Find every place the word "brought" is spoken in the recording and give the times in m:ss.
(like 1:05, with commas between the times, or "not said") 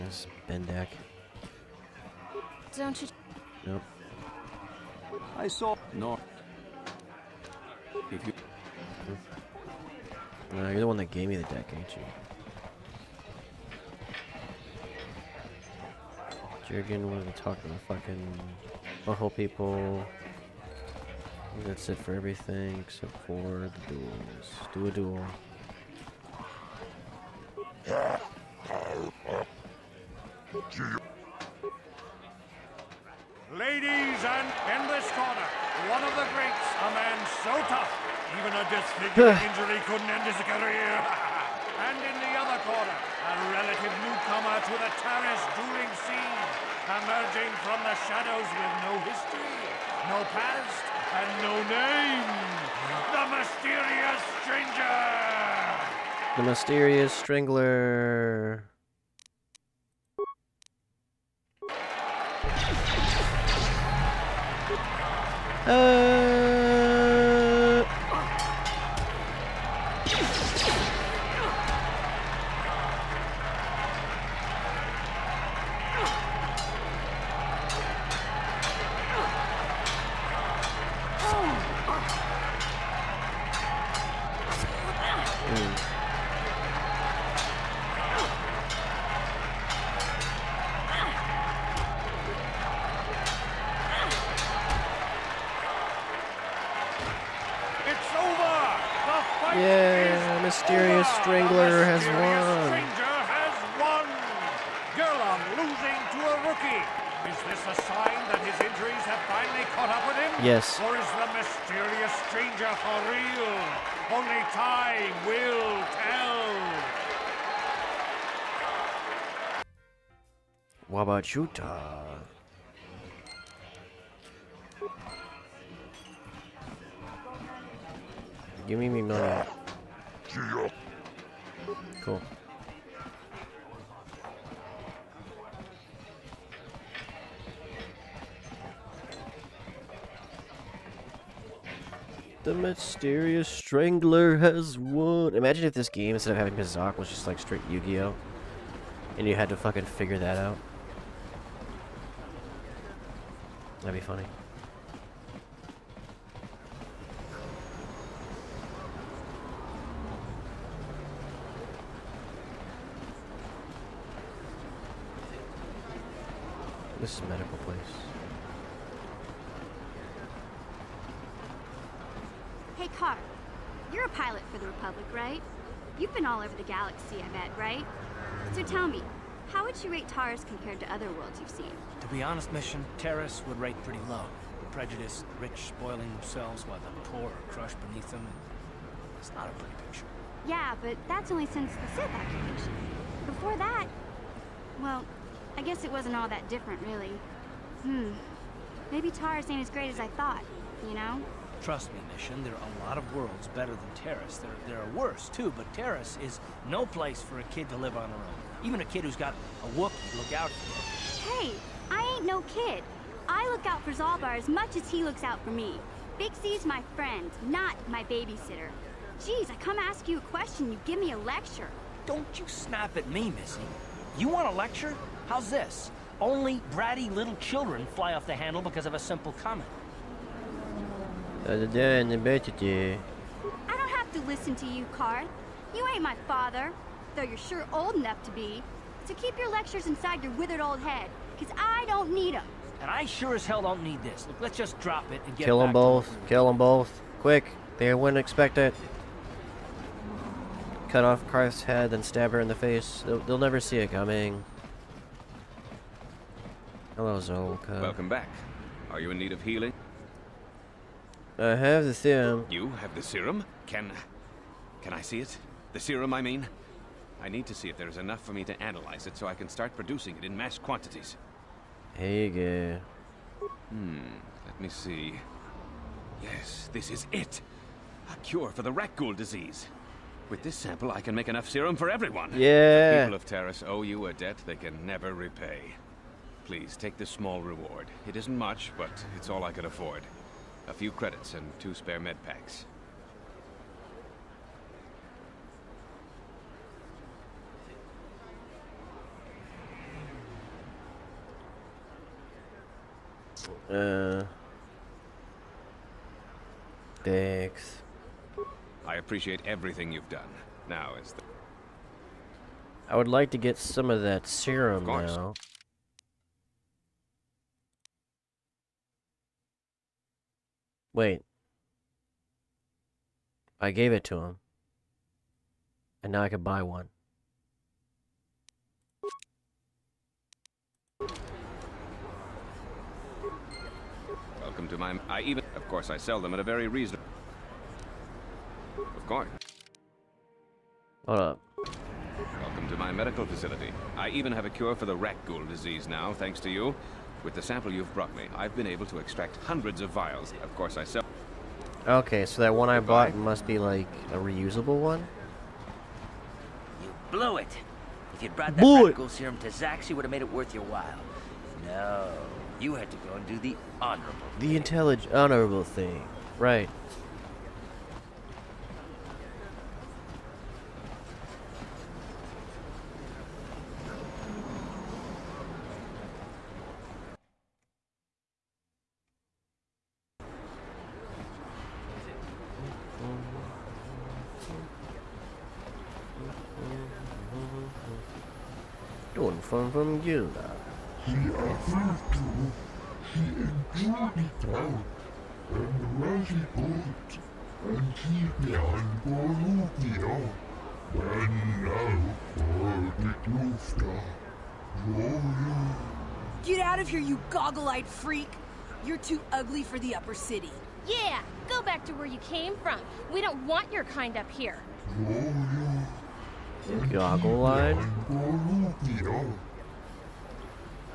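5:47, 5:58.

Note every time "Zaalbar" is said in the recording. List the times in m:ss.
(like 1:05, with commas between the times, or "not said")
3:33.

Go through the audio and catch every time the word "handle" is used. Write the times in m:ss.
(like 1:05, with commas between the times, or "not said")
3:48.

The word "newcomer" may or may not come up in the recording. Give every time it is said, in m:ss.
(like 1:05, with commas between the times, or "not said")
0:44.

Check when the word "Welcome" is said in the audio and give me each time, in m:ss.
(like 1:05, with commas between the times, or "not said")
4:17, 5:34, 5:42.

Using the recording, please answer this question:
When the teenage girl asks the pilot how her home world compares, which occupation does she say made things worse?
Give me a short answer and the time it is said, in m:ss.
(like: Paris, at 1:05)
Sith occupation, at 3:11.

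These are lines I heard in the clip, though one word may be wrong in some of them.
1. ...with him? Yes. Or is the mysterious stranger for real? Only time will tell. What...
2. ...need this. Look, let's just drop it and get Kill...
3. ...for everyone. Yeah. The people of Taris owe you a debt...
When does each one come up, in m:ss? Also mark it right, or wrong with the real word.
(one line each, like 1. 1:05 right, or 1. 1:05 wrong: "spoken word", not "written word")
1. 1:50 right
2. 4:03 right
3. 4:41 right.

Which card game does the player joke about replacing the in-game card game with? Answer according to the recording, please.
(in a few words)
Yu-Gi-Oh!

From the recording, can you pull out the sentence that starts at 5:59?
serum to Zaxi, would have made it worth your while.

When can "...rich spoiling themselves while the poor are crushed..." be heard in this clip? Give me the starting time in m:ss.
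3:05.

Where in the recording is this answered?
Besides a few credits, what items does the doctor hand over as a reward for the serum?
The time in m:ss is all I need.
4:51.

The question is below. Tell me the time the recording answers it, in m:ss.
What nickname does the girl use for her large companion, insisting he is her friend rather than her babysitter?
3:36.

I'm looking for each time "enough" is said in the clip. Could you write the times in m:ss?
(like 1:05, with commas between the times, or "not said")
3:57, 4:27, 4:41.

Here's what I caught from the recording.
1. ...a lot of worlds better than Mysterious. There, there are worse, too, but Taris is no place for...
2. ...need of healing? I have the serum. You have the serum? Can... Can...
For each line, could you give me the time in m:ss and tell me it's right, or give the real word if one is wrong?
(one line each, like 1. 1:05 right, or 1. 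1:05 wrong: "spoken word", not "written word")
1. 3:22 wrong: "Taris", not "Mysterious"
2. 4:19 right.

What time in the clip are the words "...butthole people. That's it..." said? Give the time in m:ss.
0:19.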